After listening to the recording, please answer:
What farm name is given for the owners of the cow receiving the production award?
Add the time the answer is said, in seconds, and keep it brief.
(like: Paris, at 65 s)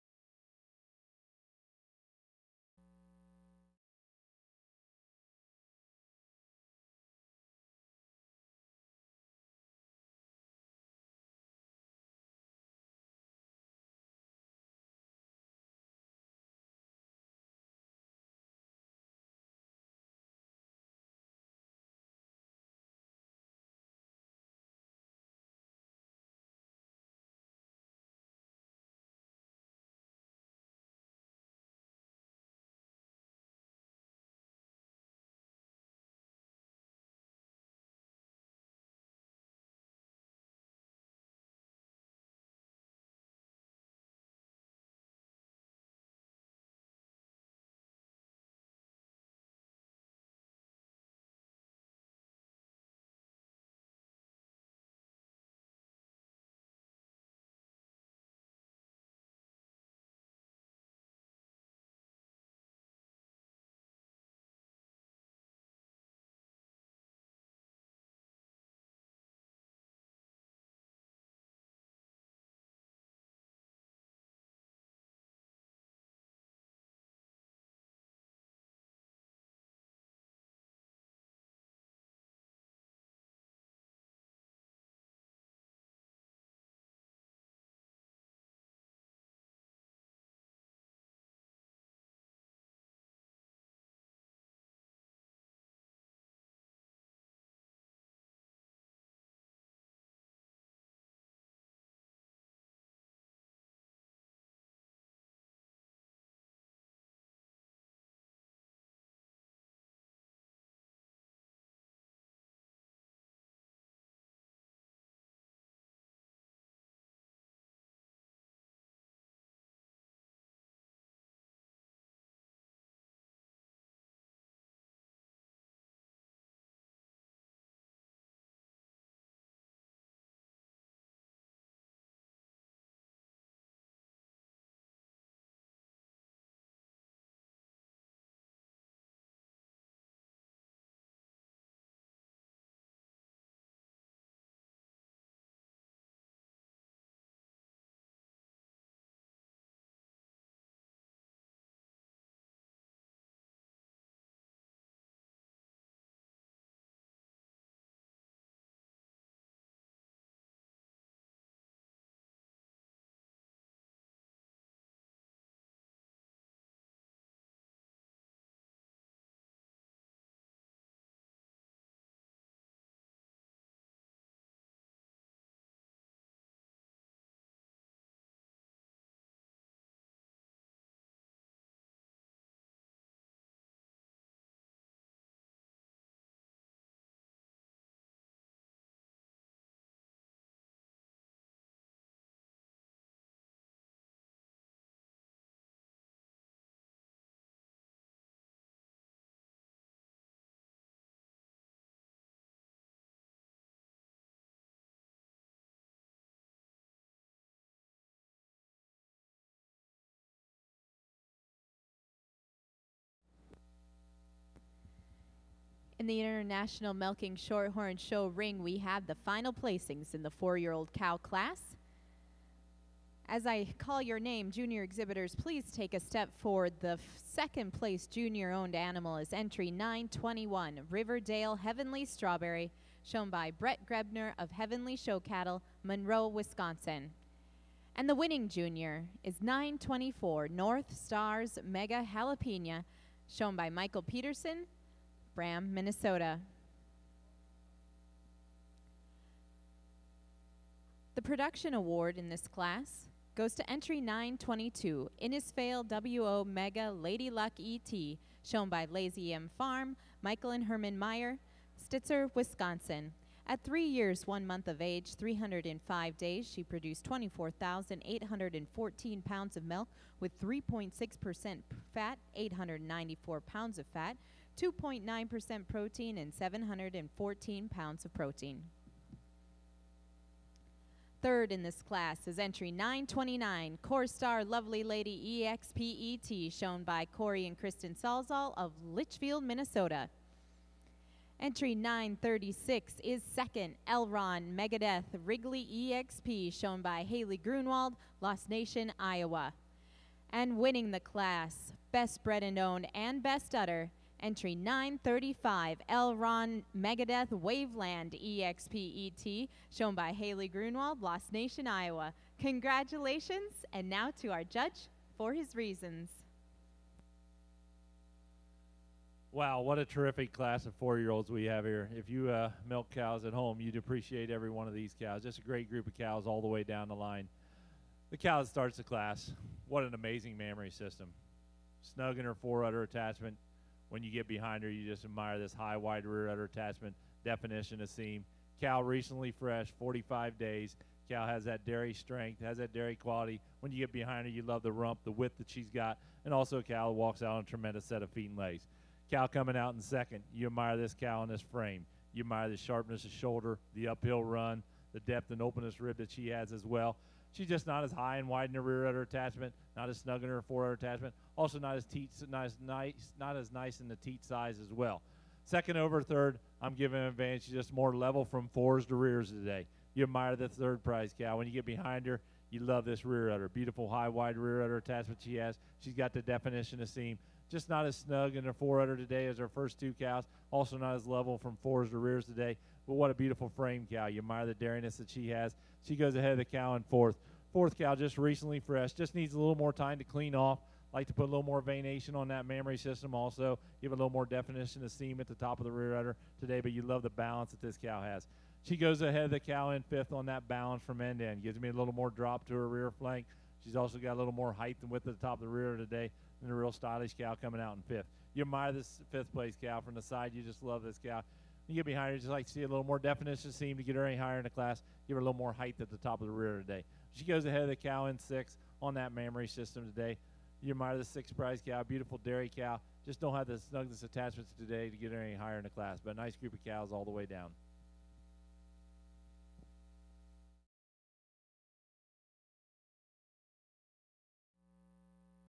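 Lazy M Farm, at 258 s.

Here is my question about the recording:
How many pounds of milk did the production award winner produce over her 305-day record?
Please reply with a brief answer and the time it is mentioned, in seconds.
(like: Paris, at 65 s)
24,814, at 267 s.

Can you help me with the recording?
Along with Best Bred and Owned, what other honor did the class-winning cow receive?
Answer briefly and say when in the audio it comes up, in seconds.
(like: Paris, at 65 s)
Best Udder, at 303 s.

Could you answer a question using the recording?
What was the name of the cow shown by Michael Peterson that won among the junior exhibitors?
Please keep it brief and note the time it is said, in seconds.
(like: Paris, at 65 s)
North Stars Mega Jalapena, at 240 s.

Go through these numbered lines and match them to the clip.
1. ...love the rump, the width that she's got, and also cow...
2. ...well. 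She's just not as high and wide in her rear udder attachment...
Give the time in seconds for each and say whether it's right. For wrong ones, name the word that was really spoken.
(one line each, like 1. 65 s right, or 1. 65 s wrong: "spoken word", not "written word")
1. 344 s right
2. 356 s right.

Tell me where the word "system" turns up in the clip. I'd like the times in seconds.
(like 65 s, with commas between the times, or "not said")
330 s, 392 s, 419 s.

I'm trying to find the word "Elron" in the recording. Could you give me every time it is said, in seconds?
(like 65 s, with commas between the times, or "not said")
293 s, 305 s.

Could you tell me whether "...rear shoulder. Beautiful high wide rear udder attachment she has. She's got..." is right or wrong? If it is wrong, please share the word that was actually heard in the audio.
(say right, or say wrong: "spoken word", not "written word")
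wrong: "udder", not "shoulder".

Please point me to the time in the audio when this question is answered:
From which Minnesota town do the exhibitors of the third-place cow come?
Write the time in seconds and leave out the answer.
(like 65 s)
288 s.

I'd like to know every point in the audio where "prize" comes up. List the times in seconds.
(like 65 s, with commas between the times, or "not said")
370 s, 421 s.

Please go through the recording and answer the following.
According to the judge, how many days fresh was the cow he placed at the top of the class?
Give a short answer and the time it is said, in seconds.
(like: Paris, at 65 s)
45 days, at 339 s.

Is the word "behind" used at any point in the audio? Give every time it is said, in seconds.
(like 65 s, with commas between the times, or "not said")
334 s, 343 s, 371 s, 411 s.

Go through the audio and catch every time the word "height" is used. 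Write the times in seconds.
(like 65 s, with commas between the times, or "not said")
404 s, 415 s.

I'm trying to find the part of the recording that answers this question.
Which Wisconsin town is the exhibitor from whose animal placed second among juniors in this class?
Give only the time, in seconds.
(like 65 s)
235 s.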